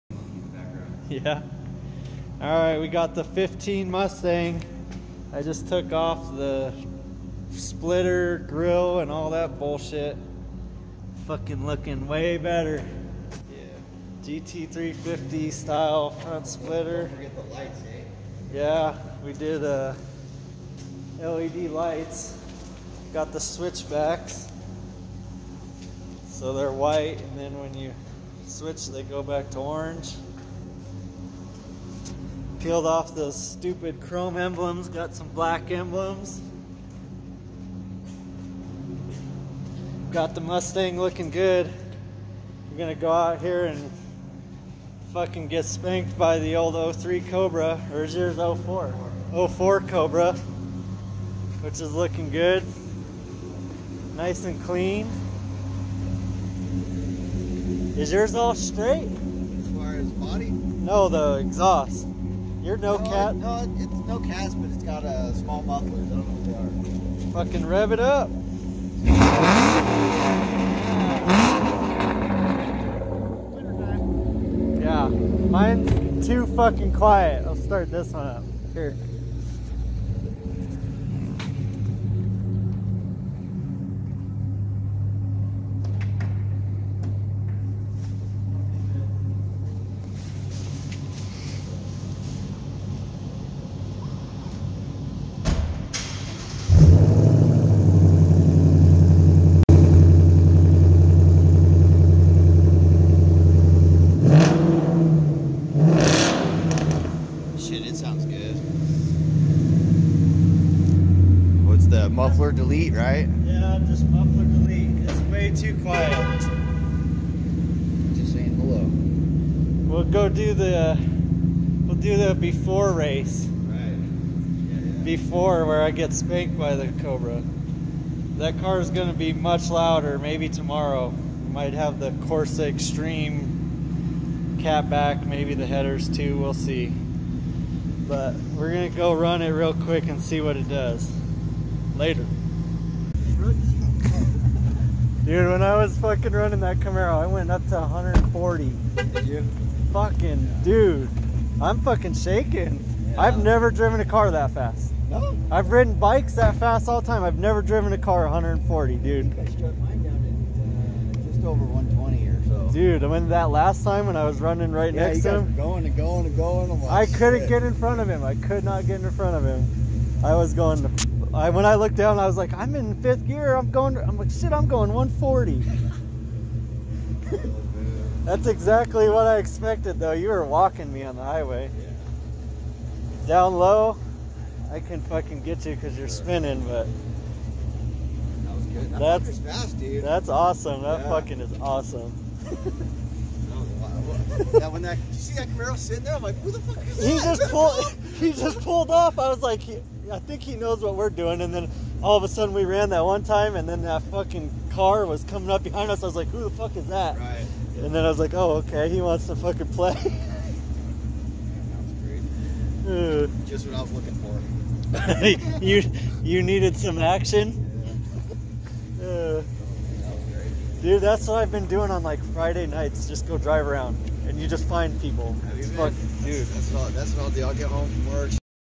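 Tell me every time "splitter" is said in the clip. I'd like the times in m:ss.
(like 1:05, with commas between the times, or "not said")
0:07, 0:16.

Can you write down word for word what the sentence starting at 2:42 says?
Dude, when that last time when I was running right yeah, next to him, going and going and going.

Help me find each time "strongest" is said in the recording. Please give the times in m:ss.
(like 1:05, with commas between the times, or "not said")
not said.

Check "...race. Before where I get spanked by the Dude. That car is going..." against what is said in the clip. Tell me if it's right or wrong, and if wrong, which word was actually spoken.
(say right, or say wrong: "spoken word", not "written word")
wrong: "Cobra", not "Dude".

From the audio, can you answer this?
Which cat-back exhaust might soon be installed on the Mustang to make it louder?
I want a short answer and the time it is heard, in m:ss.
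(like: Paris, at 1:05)
Corsa Xtreme, at 2:12.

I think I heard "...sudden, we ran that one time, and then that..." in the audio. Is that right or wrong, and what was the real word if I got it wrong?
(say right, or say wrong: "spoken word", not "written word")
right.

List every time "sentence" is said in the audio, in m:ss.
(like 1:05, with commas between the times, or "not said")
not said.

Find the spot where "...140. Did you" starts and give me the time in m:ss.
2:27.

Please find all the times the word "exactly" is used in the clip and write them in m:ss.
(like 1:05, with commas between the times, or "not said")
2:58.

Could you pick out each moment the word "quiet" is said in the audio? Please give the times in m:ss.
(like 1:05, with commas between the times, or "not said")
1:16, 1:55.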